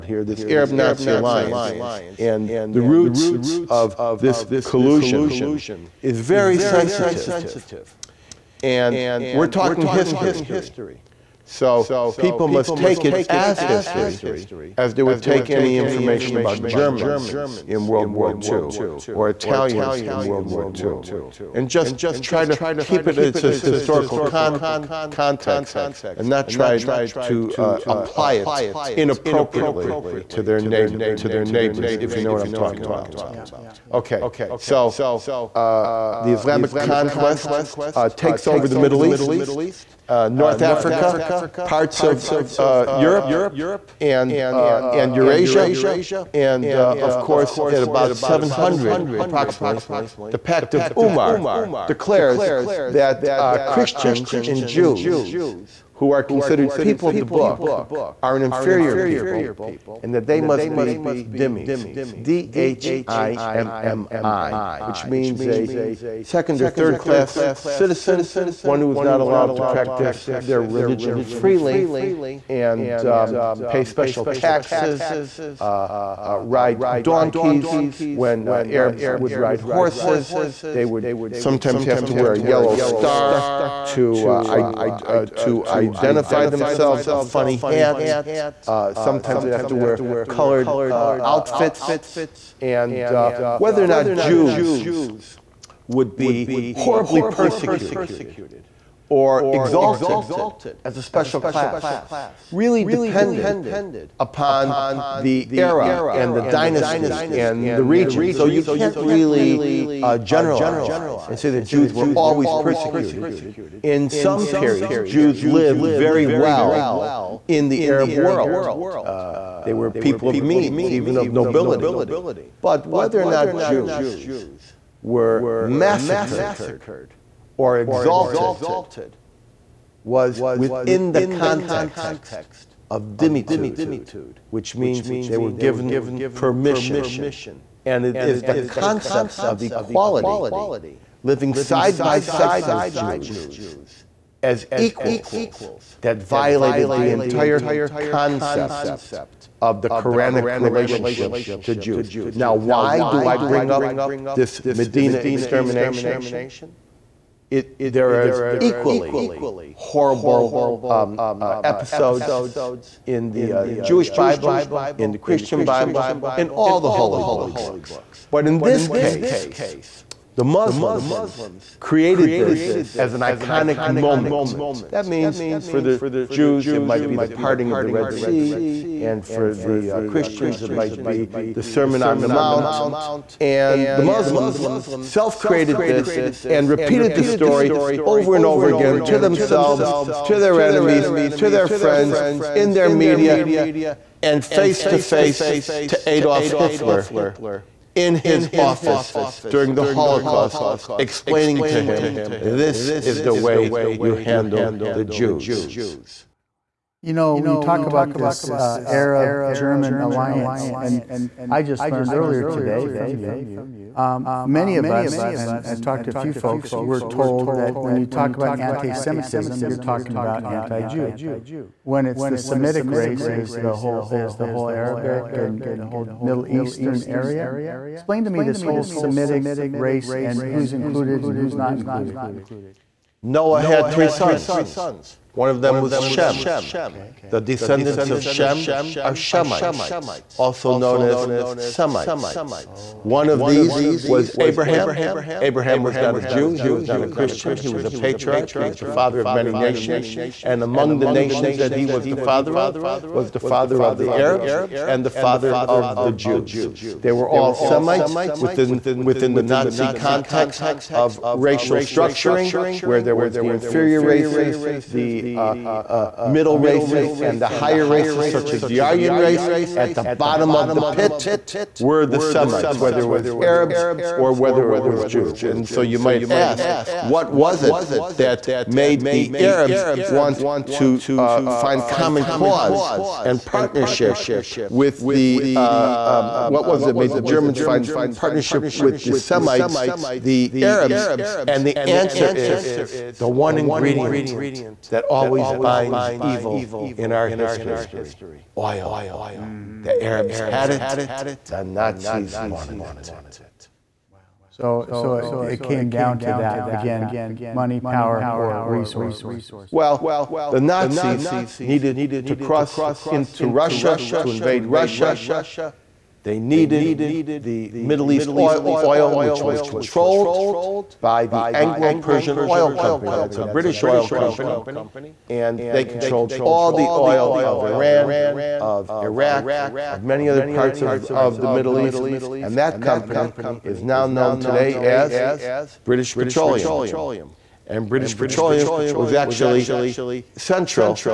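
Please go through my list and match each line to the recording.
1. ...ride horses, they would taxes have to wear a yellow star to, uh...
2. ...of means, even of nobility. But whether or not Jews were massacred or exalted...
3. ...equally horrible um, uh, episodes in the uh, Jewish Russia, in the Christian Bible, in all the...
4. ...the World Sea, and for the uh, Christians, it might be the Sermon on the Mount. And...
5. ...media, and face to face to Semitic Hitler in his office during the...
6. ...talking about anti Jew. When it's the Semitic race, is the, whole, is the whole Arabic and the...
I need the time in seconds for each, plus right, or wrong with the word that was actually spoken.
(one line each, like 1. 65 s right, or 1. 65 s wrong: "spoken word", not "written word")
1. 79 s wrong: "sometimes", not "taxes"
2. 120 s right
3. 158 s wrong: "Bible", not "Russia"
4. 177 s wrong: "Red", not "World"
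5. 192 s wrong: "Adolf", not "Semitic"
6. 219 s right.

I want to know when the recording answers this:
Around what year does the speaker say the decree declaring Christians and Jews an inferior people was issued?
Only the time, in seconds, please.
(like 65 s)
48 s.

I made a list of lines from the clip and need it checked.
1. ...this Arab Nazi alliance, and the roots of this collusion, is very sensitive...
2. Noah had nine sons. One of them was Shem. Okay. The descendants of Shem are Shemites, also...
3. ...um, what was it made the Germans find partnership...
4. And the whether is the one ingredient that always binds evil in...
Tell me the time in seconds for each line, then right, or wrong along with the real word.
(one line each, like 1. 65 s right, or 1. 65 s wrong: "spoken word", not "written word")
1. 0 s right
2. 233 s wrong: "three", not "nine"
3. 286 s right
4. 291 s wrong: "answer", not "whether".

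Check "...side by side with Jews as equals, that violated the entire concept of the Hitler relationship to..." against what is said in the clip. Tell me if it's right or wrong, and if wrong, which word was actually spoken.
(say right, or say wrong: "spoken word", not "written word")
wrong: "Quranic", not "Hitler".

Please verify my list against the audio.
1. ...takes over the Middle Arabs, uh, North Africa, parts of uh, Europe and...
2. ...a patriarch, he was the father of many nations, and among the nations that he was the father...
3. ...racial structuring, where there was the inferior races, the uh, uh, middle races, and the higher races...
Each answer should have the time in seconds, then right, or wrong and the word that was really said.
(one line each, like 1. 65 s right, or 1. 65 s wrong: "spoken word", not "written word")
1. 38 s wrong: "East", not "Arabs"
2. 247 s right
3. 261 s right.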